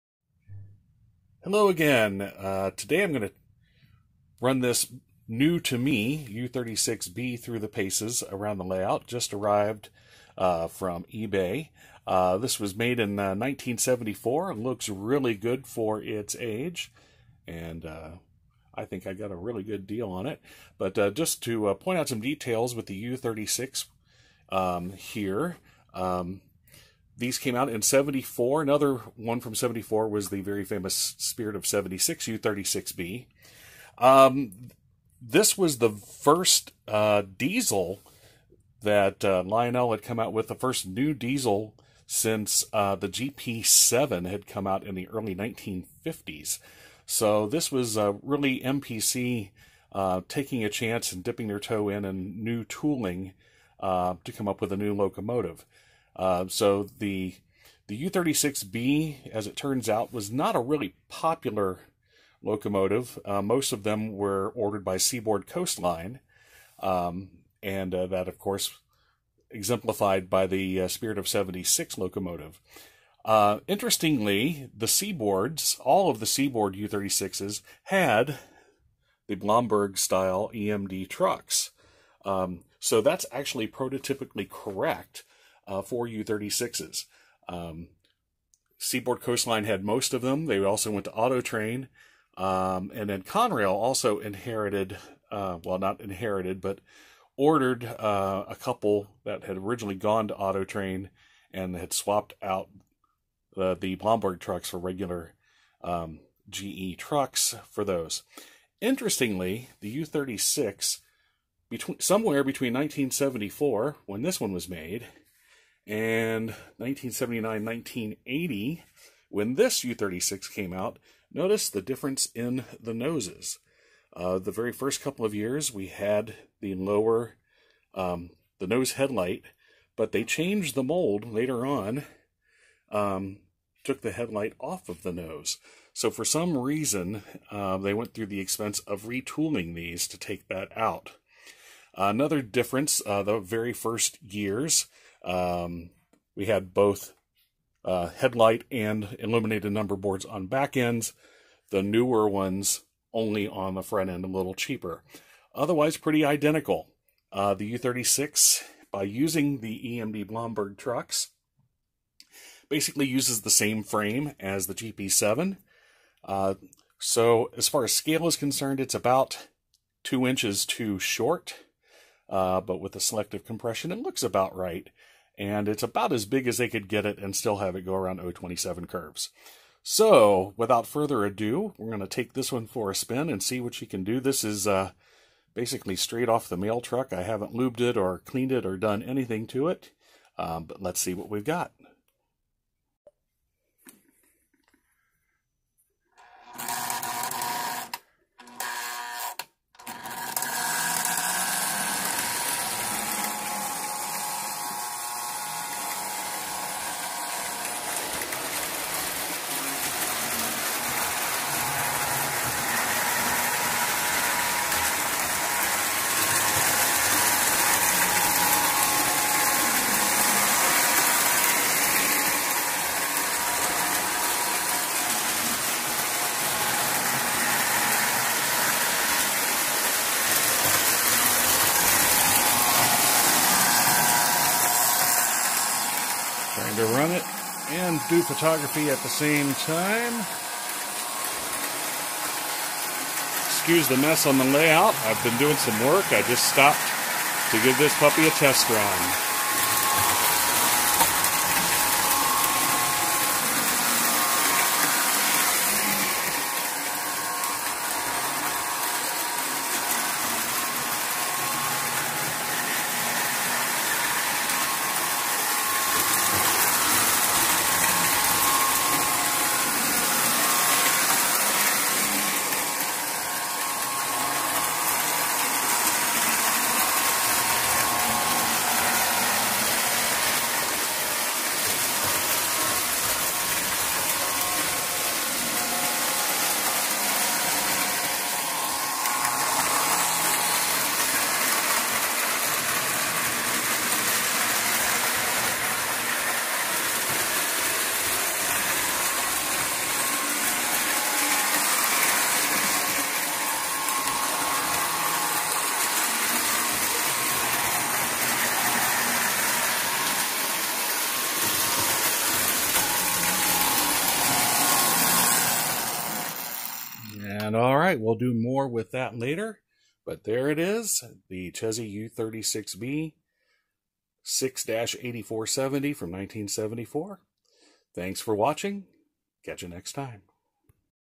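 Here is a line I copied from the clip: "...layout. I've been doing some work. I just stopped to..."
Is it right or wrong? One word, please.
right.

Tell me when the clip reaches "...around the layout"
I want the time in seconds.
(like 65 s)
8 s.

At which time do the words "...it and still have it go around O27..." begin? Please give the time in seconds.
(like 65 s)
177 s.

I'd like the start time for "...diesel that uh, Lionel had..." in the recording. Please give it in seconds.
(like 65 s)
37 s.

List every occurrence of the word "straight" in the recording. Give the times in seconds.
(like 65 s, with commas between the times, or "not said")
185 s.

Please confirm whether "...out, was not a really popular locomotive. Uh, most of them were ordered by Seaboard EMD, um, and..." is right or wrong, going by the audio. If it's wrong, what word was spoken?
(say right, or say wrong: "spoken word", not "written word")
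wrong: "Coastline", not "EMD".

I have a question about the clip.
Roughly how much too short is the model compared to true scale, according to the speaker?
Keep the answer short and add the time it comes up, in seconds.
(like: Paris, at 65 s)
2 inches, at 170 s.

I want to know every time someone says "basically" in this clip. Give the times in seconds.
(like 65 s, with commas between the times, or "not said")
162 s, 185 s.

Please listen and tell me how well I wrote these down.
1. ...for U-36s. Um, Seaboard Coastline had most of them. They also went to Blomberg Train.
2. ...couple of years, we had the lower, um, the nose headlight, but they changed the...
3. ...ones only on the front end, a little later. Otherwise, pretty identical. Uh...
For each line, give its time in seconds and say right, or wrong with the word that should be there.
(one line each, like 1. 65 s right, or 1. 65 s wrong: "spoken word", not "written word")
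1. 85 s wrong: "Auto", not "Blomberg"
2. 125 s right
3. 152 s wrong: "cheaper", not "later".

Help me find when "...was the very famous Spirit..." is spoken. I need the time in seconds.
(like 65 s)
30 s.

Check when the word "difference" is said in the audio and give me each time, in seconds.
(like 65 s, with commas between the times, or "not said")
121 s, 142 s.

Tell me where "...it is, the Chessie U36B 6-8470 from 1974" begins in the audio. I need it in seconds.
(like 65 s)
320 s.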